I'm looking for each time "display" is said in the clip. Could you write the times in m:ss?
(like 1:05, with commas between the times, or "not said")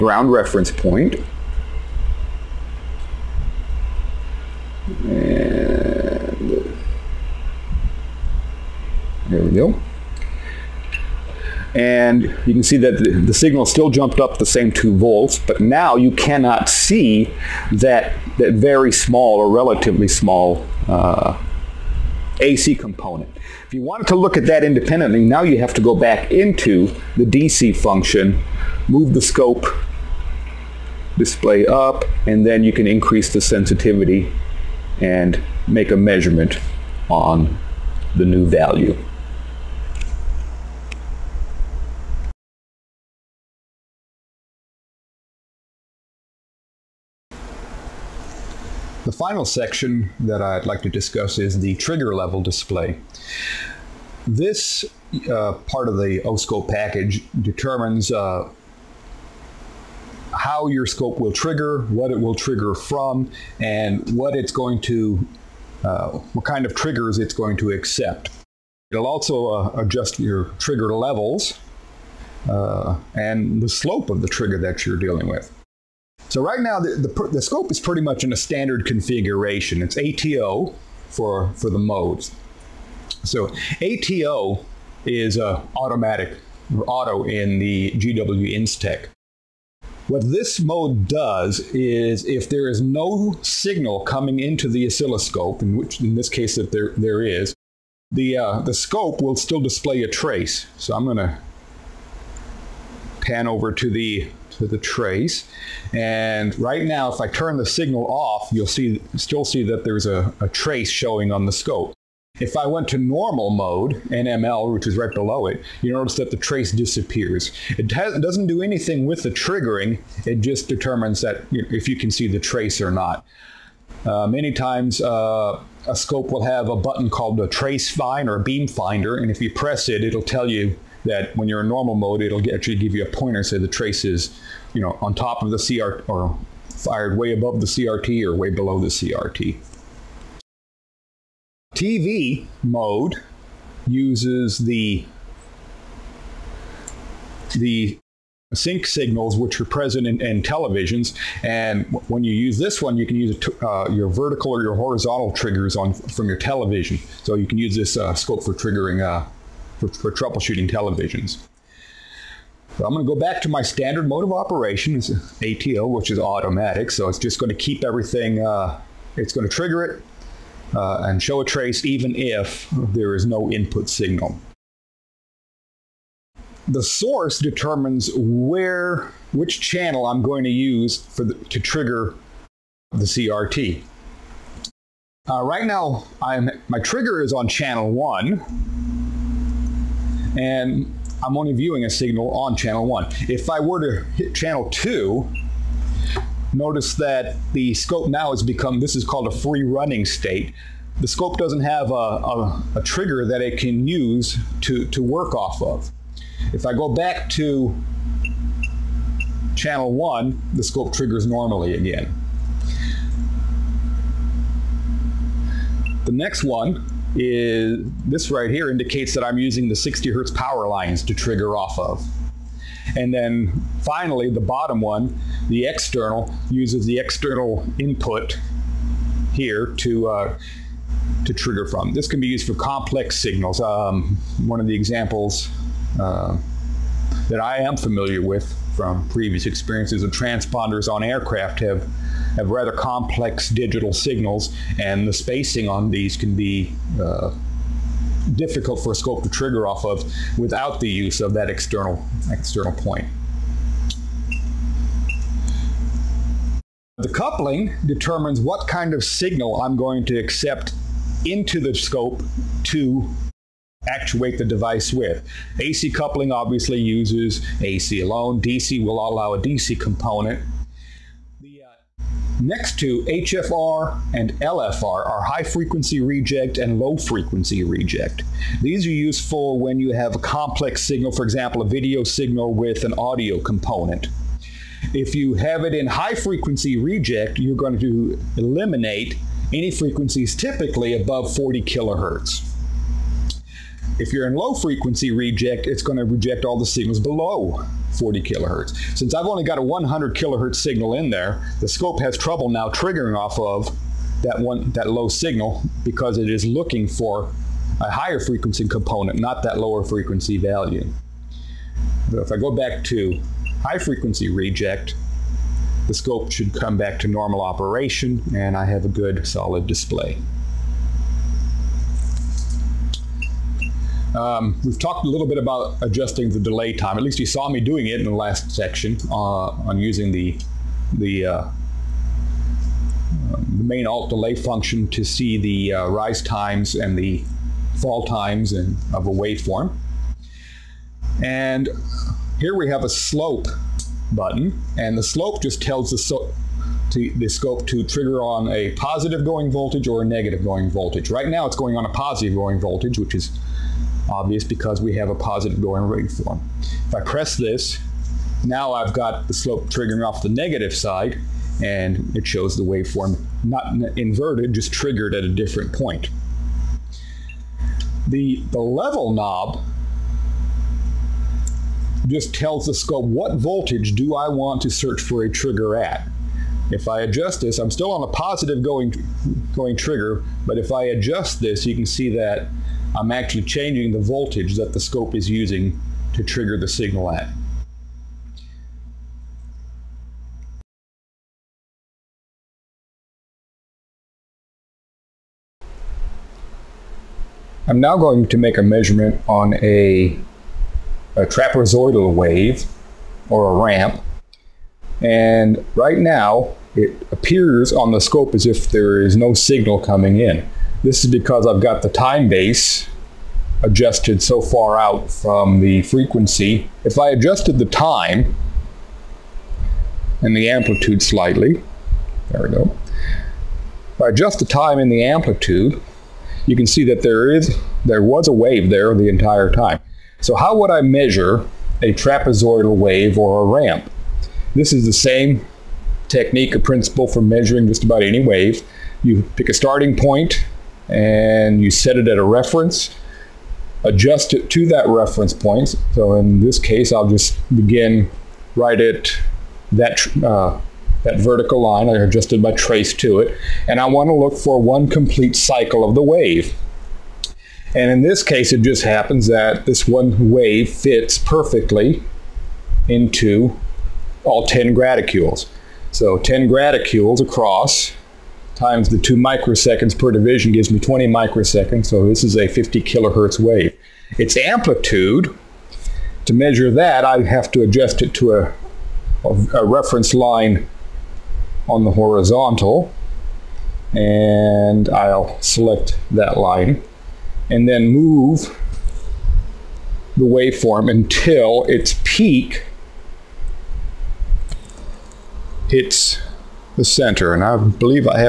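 0:31, 0:52, 1:39, 5:19.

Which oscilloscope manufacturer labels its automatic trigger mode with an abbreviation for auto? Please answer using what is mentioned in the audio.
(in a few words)
GW Instek.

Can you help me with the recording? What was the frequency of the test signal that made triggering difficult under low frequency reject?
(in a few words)
100 kilohertz.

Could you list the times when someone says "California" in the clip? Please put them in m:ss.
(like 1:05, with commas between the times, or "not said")
not said.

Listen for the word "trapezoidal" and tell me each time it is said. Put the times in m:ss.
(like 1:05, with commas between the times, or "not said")
6:41, 7:11.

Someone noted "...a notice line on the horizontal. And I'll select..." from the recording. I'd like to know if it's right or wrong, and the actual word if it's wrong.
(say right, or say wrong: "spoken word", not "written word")
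wrong: "reference", not "notice".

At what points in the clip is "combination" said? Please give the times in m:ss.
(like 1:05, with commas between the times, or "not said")
not said.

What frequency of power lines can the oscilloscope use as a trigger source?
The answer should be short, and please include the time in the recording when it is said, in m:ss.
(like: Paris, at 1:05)
60 hertz, at 3:39.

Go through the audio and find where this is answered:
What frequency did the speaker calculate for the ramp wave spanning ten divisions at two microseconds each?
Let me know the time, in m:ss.
7:52.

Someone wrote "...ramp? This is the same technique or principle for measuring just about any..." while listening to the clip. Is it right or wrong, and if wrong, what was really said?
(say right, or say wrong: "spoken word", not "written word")
right.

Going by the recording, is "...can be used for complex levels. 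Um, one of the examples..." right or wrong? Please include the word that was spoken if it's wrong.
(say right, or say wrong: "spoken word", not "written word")
wrong: "signals", not "levels".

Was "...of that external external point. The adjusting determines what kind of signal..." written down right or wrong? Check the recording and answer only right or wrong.
wrong.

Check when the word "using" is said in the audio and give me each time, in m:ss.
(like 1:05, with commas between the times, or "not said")
3:39, 5:29, 6:25.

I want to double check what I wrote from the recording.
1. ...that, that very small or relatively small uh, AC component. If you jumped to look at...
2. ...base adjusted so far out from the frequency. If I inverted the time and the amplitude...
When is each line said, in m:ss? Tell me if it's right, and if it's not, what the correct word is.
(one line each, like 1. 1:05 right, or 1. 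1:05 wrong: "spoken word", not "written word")
1. 0:17 wrong: "wanted", not "jumped"
2. 6:52 wrong: "adjusted", not "inverted".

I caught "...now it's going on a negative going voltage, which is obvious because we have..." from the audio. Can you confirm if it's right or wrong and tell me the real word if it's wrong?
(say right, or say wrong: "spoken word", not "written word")
wrong: "positive", not "negative".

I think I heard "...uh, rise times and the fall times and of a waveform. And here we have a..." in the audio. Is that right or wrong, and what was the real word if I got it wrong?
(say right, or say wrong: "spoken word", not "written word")
right.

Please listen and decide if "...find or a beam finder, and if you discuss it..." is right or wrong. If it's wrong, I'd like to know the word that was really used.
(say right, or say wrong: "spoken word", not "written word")
wrong: "press", not "discuss".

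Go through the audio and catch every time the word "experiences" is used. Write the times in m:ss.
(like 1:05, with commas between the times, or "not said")
3:59.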